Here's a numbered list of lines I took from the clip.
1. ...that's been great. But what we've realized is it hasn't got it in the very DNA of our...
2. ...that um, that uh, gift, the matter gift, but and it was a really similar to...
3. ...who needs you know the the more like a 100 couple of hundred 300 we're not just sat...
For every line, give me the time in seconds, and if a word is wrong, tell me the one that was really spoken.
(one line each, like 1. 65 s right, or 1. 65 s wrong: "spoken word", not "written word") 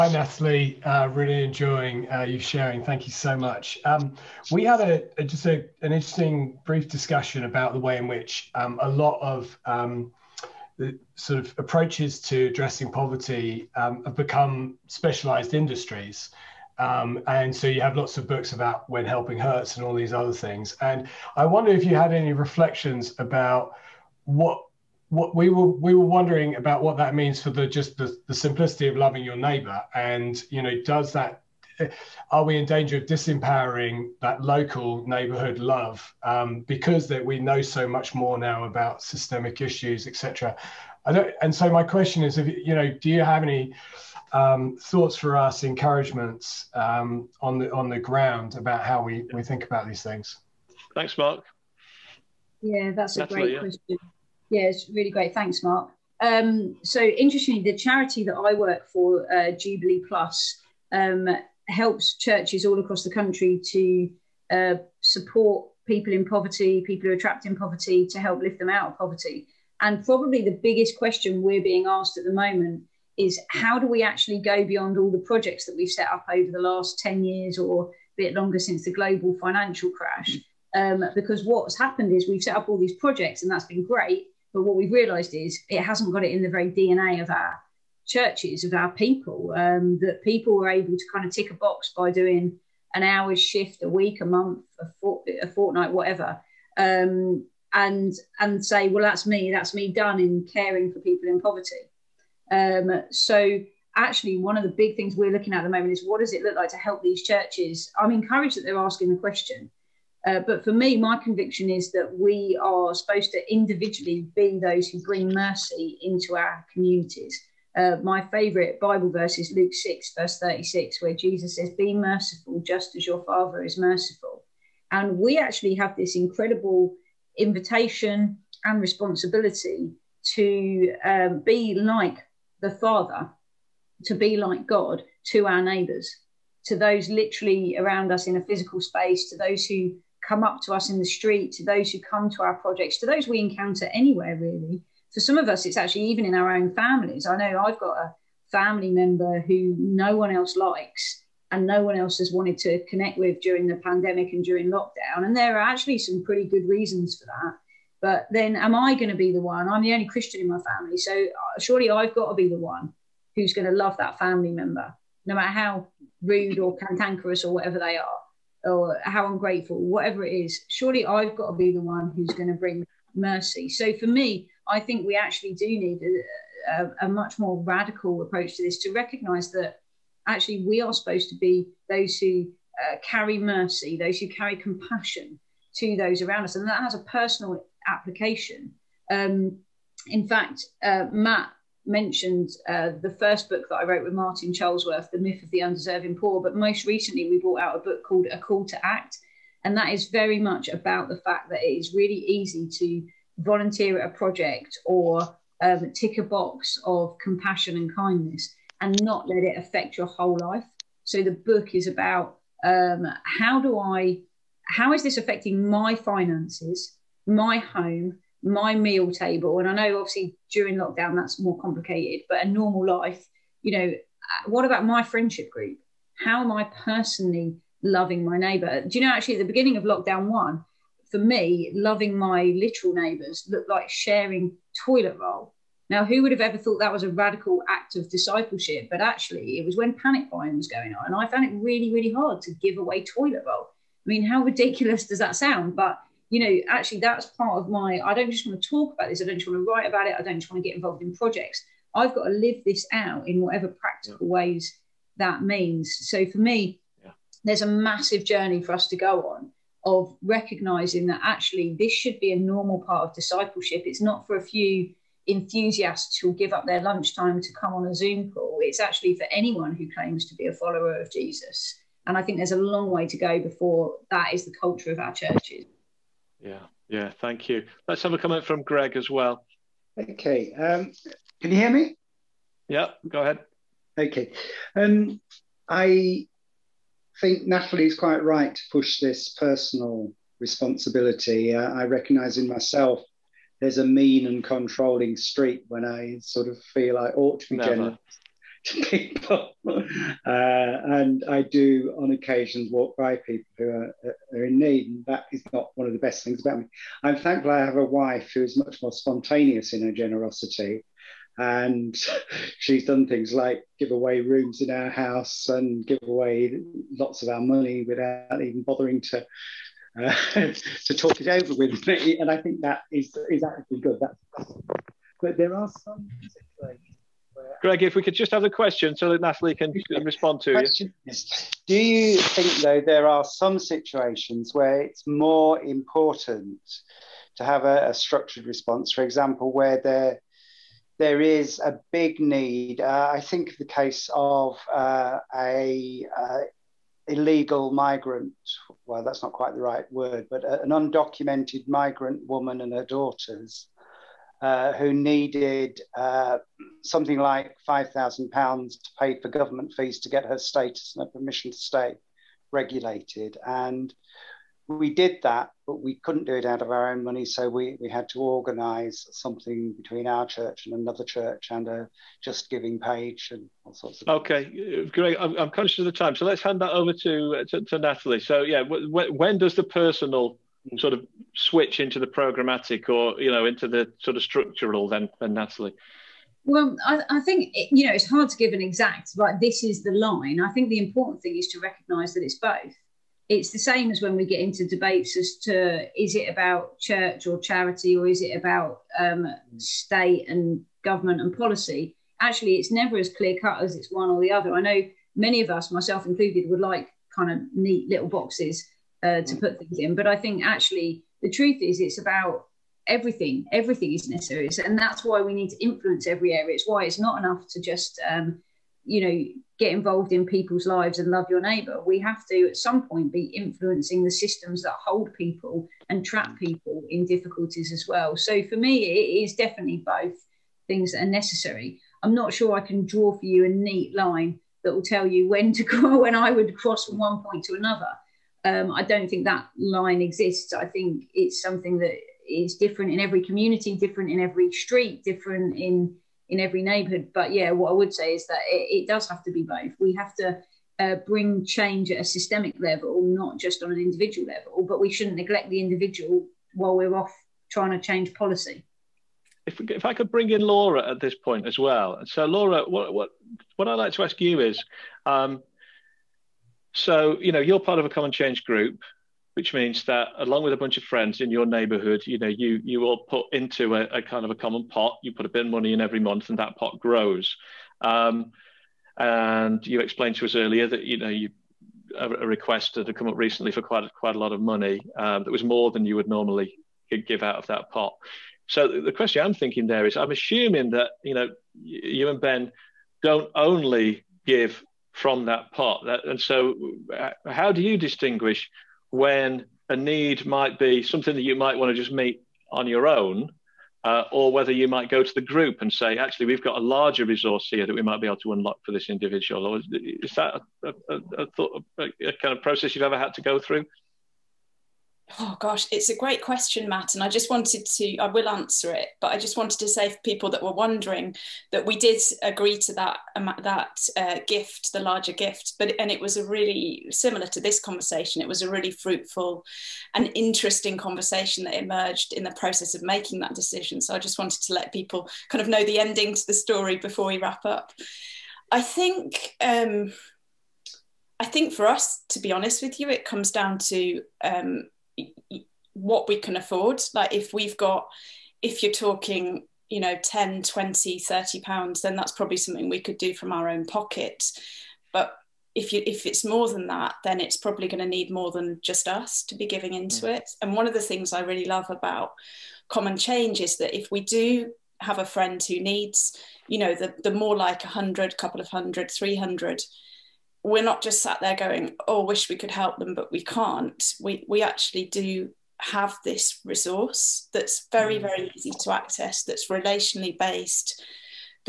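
1. 83 s right
2. 522 s wrong: "larger", not "matter"
3. 565 s right.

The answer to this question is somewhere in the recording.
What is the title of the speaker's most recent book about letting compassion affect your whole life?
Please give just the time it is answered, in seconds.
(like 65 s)
198 s.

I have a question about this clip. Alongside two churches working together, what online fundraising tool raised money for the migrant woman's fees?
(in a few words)
Just giving page.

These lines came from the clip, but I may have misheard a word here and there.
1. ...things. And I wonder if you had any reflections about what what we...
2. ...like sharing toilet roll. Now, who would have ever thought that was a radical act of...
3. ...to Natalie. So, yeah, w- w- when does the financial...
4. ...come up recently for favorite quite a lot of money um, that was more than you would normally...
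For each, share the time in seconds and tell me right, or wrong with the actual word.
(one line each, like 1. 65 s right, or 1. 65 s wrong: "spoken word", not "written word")
1. 20 s right
2. 233 s right
3. 377 s wrong: "personal", not "financial"
4. 482 s wrong: "quite", not "favorite".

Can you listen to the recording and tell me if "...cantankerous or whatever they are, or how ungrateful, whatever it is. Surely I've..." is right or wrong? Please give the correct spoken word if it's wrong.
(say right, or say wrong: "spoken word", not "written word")
right.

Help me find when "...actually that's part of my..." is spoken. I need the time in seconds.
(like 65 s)
246 s.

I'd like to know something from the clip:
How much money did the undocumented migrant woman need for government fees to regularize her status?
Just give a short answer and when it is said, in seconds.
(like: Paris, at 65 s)
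£5,000, at 357 s.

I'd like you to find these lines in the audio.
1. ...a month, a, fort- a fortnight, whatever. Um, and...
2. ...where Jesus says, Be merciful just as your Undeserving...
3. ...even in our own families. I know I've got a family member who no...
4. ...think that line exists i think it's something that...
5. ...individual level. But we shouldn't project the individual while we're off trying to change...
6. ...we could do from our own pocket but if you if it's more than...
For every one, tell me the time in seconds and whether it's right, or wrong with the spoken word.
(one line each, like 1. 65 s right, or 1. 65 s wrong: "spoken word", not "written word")
1. 94 s right
2. 121 s wrong: "Father", not "Undeserving"
3. 146 s right
4. 439 s right
5. 453 s wrong: "neglect", not "project"
6. 552 s right.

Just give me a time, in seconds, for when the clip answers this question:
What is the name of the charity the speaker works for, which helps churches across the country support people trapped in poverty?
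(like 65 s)
59 s.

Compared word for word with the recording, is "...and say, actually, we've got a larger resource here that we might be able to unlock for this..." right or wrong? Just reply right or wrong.
right.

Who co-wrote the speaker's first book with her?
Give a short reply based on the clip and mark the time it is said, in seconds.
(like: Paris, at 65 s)
Martin Charlesworth, at 194 s.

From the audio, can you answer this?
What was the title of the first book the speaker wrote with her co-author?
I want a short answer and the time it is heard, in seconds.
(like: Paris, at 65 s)
The Myth of the Undeserving Poor, at 195 s.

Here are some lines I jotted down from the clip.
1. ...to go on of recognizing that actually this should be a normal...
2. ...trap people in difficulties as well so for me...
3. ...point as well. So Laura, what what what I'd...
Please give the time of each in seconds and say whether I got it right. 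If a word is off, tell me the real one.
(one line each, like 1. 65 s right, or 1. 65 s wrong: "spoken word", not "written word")
1. 258 s right
2. 426 s right
3. 461 s right.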